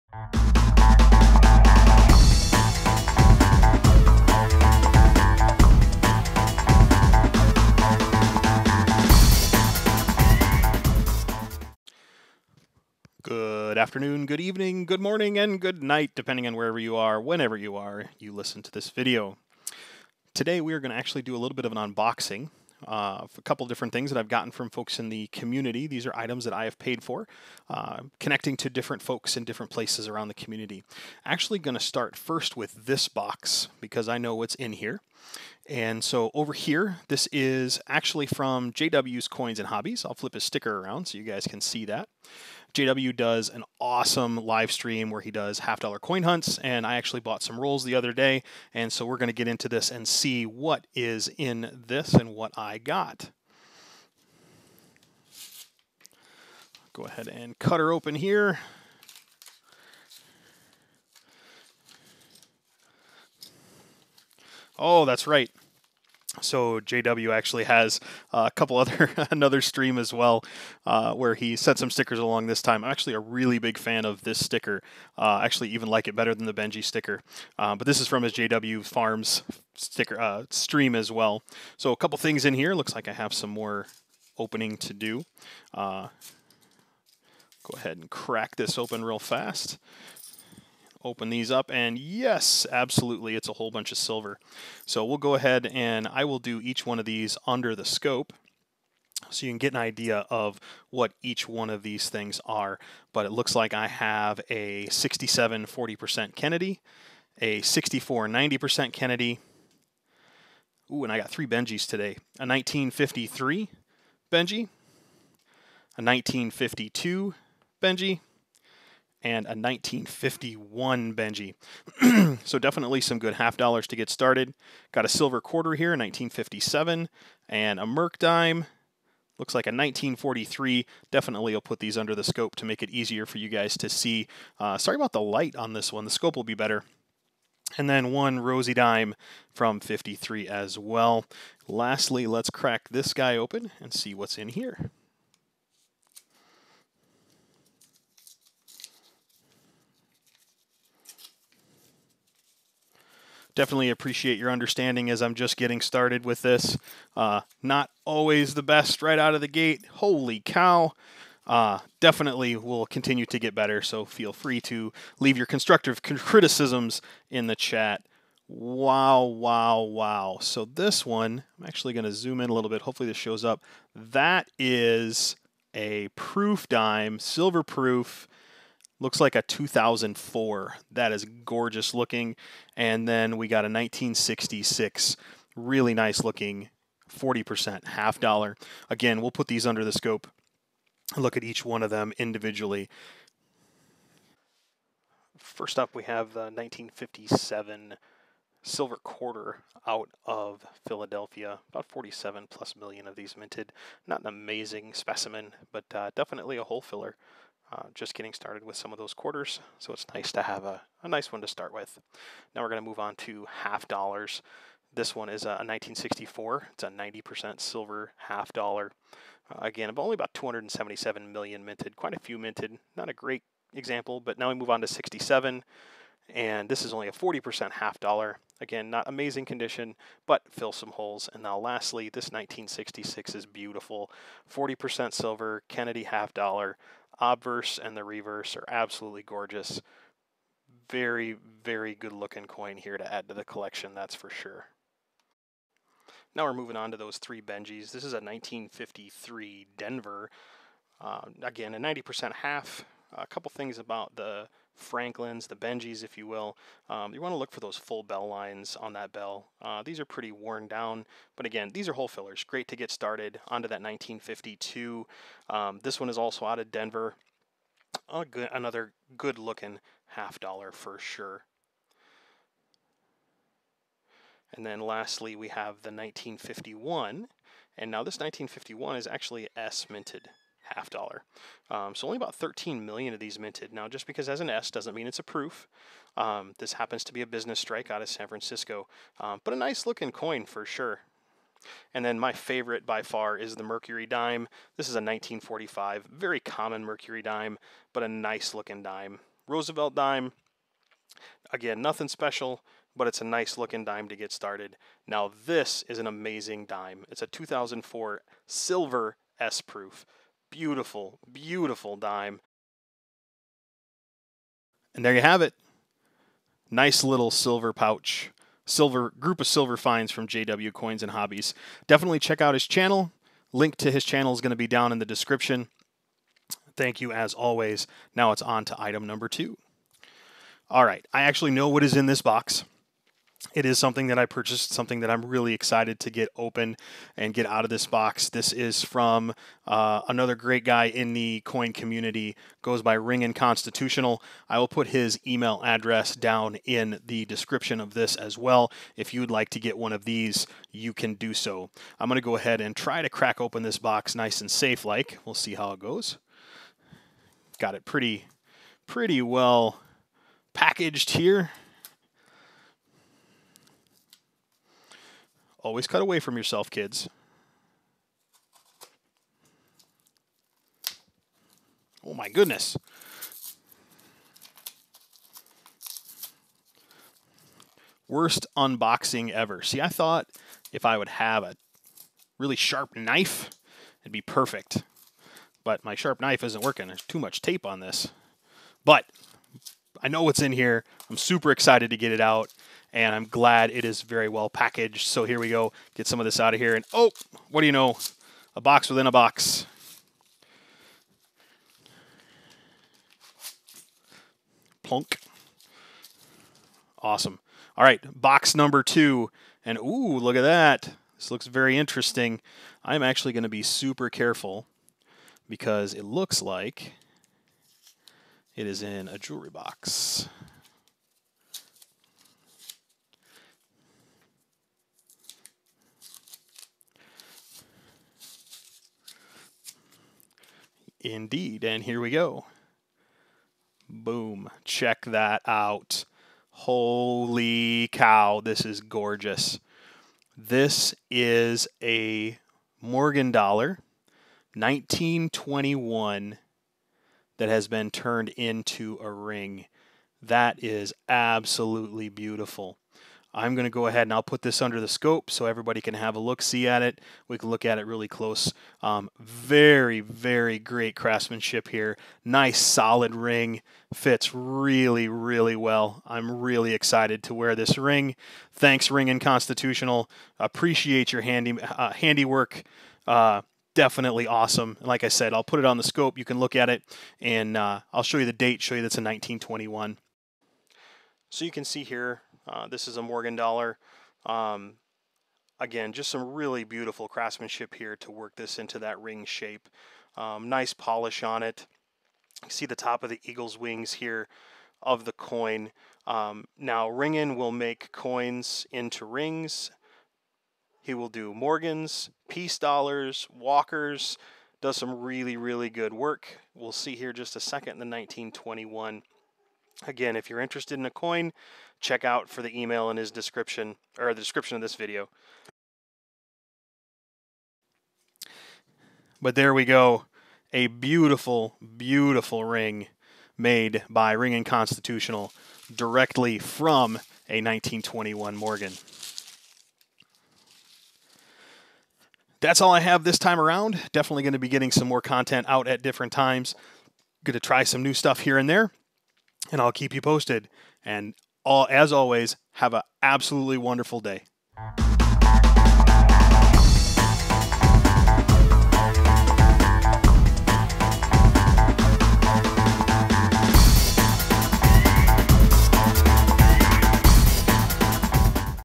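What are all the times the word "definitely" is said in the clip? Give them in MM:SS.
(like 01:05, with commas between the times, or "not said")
02:02, 02:11, 02:33, 02:41, 03:26, 05:21, 07:53, 08:53.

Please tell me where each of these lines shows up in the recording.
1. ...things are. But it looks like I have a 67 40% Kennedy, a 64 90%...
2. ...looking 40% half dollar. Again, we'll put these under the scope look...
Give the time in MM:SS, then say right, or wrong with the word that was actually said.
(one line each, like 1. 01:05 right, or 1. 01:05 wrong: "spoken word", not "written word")
1. 01:42 right
2. 03:06 right.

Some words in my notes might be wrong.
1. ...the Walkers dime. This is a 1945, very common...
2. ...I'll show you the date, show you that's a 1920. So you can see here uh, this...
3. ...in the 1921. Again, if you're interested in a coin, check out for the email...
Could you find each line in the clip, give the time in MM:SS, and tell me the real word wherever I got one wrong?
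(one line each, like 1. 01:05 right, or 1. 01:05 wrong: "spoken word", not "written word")
1. 04:53 wrong: "Mercury", not "Walkers"
2. 07:57 wrong: "1921", not "1920"
3. 08:27 right.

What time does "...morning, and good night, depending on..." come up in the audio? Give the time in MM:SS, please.
00:15.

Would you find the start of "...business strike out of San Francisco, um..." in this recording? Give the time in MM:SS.
04:47.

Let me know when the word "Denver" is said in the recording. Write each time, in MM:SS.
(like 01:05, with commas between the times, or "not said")
04:09, 04:26.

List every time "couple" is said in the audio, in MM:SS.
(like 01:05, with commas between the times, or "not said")
00:23, 01:08, 01:21, 04:13.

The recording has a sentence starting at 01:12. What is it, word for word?
This time, I'm actually a really big fan of this sticker.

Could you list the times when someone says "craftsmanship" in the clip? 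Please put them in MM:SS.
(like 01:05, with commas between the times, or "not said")
07:40, 08:07.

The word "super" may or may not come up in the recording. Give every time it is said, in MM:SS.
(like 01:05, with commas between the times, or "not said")
06:31, 06:53.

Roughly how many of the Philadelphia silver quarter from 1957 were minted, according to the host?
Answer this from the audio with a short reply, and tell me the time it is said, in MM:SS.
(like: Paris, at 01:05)
47 million, at 03:21.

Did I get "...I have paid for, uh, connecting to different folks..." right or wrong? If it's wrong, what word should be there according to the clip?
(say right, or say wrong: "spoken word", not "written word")
right.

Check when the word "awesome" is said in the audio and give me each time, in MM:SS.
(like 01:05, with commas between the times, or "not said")
00:43, 06:47, 07:54.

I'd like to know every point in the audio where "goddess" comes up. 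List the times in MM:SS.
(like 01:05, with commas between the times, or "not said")
not said.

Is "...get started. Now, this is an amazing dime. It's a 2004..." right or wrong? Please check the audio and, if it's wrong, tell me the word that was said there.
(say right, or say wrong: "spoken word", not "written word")
right.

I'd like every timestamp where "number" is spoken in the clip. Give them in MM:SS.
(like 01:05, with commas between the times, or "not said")
05:29, 06:48.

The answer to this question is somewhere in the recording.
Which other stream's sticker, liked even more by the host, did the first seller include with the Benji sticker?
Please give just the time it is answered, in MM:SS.
01:18.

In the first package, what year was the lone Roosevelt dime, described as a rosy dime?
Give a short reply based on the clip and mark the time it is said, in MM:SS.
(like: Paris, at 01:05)
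1953, at 02:19.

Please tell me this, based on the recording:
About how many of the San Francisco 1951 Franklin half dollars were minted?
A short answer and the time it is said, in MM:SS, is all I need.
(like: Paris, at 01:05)
13 million, at 04:42.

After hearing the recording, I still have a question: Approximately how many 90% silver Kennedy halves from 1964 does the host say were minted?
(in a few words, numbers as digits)
277 million.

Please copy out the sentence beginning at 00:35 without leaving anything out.
And so over here, this is actually from JW's Coins and Hobbies.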